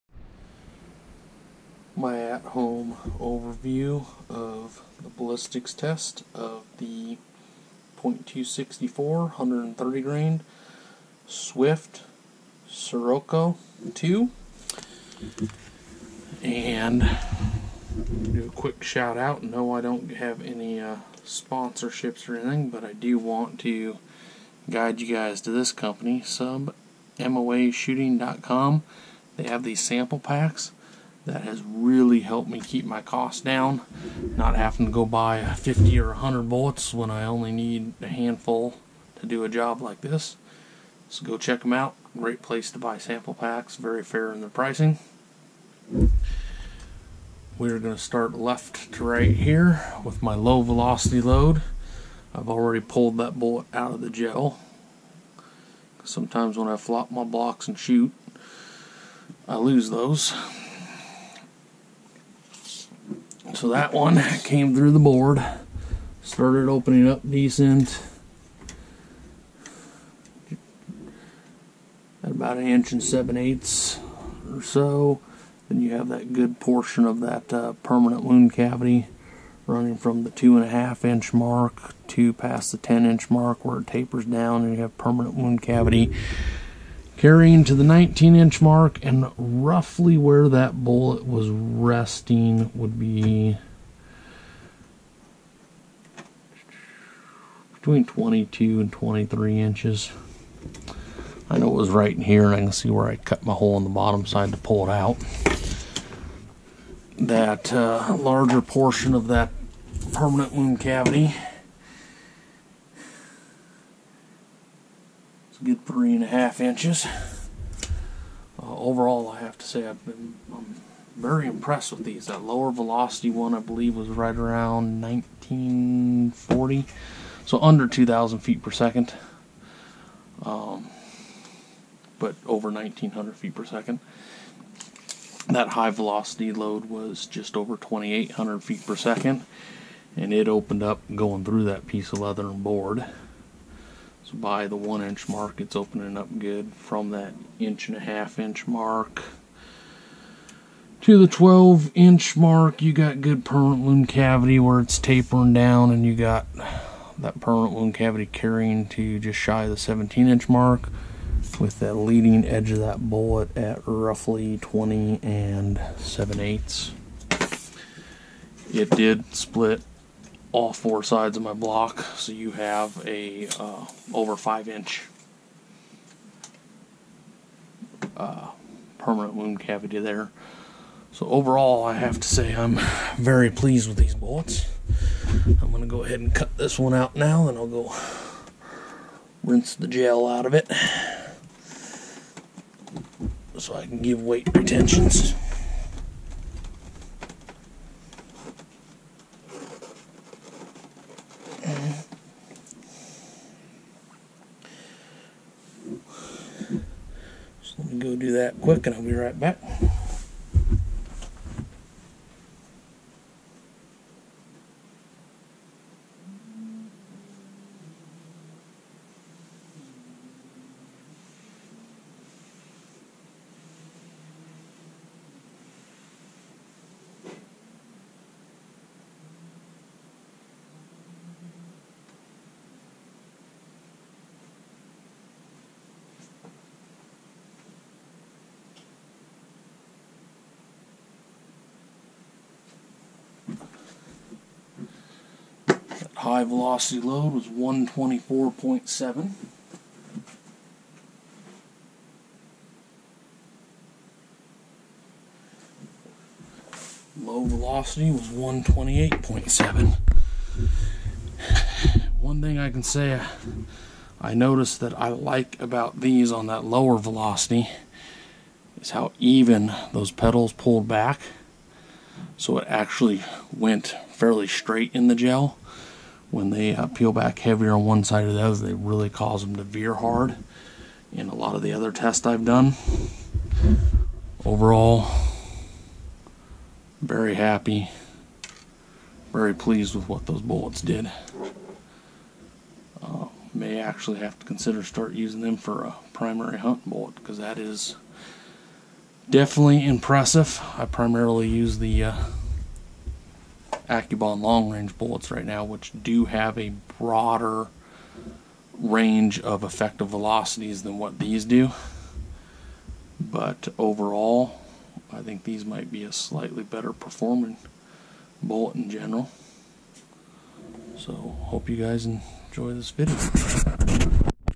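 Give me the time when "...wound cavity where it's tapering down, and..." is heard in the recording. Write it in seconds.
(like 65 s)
153 s.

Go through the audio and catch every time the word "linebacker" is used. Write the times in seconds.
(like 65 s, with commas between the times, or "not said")
not said.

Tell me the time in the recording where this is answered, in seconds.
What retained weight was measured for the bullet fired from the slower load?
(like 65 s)
258 s.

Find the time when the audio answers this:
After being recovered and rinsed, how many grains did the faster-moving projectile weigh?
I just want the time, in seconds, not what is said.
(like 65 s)
247 s.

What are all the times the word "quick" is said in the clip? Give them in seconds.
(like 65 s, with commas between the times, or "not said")
18 s, 208 s.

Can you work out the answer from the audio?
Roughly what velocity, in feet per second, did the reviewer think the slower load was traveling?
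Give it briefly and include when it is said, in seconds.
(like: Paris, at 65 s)
1940, at 125 s.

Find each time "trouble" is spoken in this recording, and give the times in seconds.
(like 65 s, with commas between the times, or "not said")
not said.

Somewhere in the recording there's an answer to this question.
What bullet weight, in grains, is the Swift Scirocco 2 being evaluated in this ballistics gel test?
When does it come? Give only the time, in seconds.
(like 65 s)
9 s.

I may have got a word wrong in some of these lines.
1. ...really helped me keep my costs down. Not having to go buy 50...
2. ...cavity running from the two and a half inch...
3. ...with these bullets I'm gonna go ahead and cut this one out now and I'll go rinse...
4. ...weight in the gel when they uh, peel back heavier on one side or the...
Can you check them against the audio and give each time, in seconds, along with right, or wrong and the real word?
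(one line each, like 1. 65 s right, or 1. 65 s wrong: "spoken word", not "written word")
1. 31 s right
2. 78 s right
3. 183 s right
4. 274 s wrong: "straight", not "weight".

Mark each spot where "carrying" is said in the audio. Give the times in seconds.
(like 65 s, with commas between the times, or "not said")
87 s, 158 s.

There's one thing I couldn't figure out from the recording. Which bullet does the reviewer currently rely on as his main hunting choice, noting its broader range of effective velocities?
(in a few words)
AccuBond long range.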